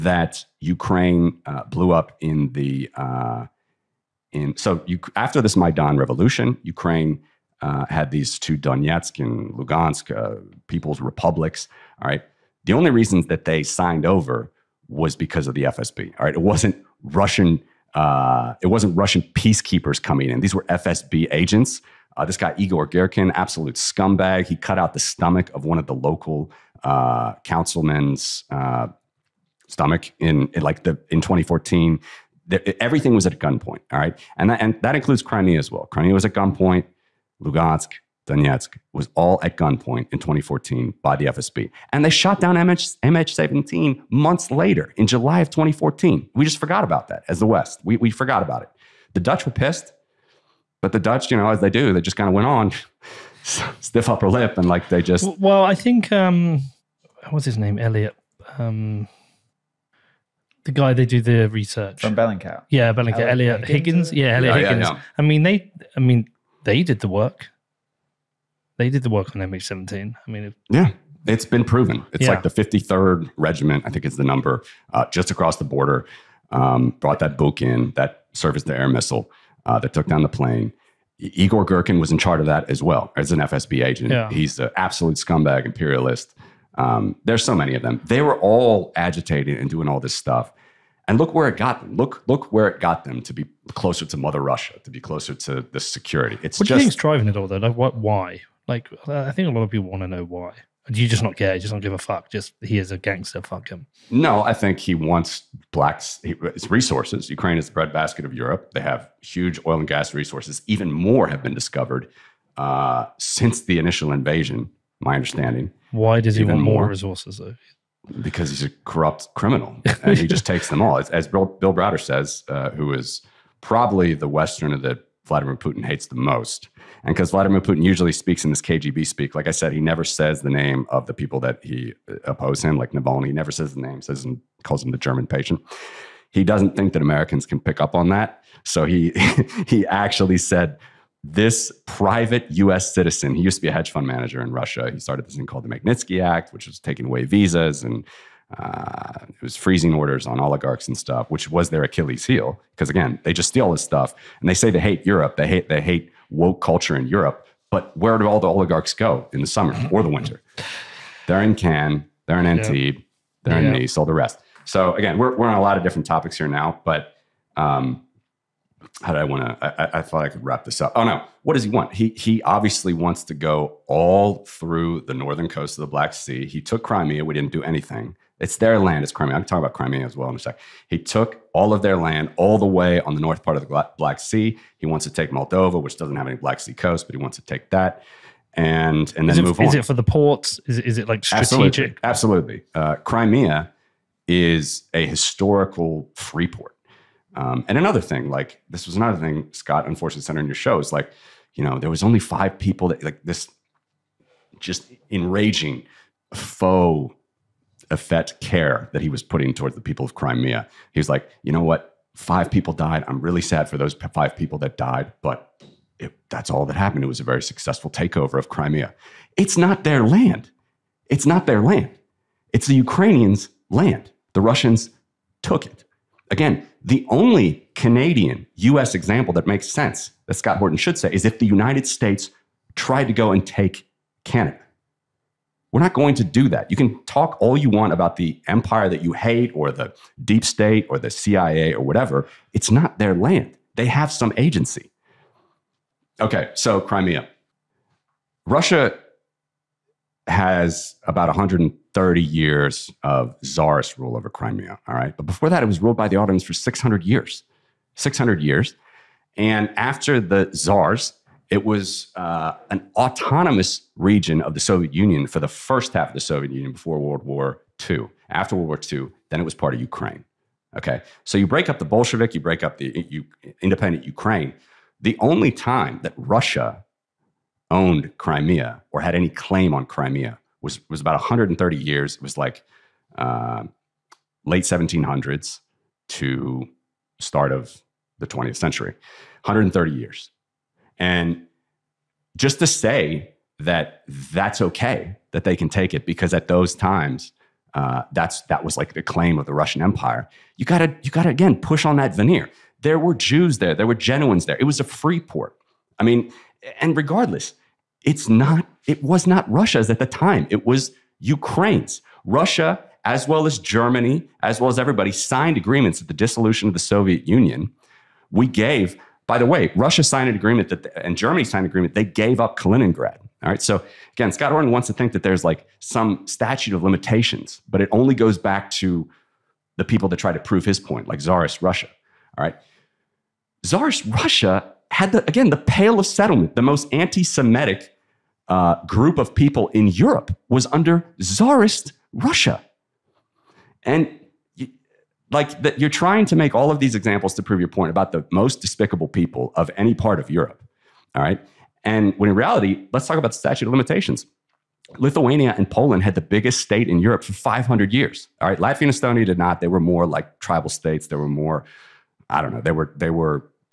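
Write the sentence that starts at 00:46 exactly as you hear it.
We just forgot about that as the West.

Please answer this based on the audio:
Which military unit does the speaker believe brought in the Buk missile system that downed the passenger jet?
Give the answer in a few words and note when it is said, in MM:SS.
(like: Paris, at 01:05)
53rd Regiment, at 01:12.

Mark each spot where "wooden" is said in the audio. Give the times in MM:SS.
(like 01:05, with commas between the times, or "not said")
not said.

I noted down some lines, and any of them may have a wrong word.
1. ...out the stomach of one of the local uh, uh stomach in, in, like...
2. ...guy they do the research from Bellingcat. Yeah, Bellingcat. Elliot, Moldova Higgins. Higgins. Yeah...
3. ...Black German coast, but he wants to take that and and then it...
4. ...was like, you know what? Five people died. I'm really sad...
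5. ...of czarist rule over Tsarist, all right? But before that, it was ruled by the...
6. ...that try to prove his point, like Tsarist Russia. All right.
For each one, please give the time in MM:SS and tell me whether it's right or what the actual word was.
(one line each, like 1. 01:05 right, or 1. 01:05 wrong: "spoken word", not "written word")
1. 00:24 right
2. 01:00 wrong: "Elliot", not "Moldova"
3. 03:06 wrong: "Sea", not "German"
4. 03:30 right
5. 04:13 wrong: "Crimea", not "Tsarist"
6. 05:30 right.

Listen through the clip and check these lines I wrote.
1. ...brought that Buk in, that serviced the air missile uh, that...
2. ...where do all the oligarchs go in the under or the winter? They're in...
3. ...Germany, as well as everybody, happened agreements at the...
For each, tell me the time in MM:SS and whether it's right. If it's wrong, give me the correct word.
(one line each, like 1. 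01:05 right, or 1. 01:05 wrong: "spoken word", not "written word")
1. 01:16 right
2. 02:37 wrong: "summer", not "under"
3. 05:13 wrong: "signed", not "happened".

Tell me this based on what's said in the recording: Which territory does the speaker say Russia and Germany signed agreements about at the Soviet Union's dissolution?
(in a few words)
Kaliningrad.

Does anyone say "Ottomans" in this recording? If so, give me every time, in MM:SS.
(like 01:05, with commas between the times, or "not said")
04:16.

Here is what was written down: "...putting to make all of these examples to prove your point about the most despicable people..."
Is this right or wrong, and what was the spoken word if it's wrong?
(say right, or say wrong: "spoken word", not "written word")
wrong: "trying", not "putting".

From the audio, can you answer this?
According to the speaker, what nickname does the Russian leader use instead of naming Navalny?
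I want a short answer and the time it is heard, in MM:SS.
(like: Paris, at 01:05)
the German patient, at 02:14.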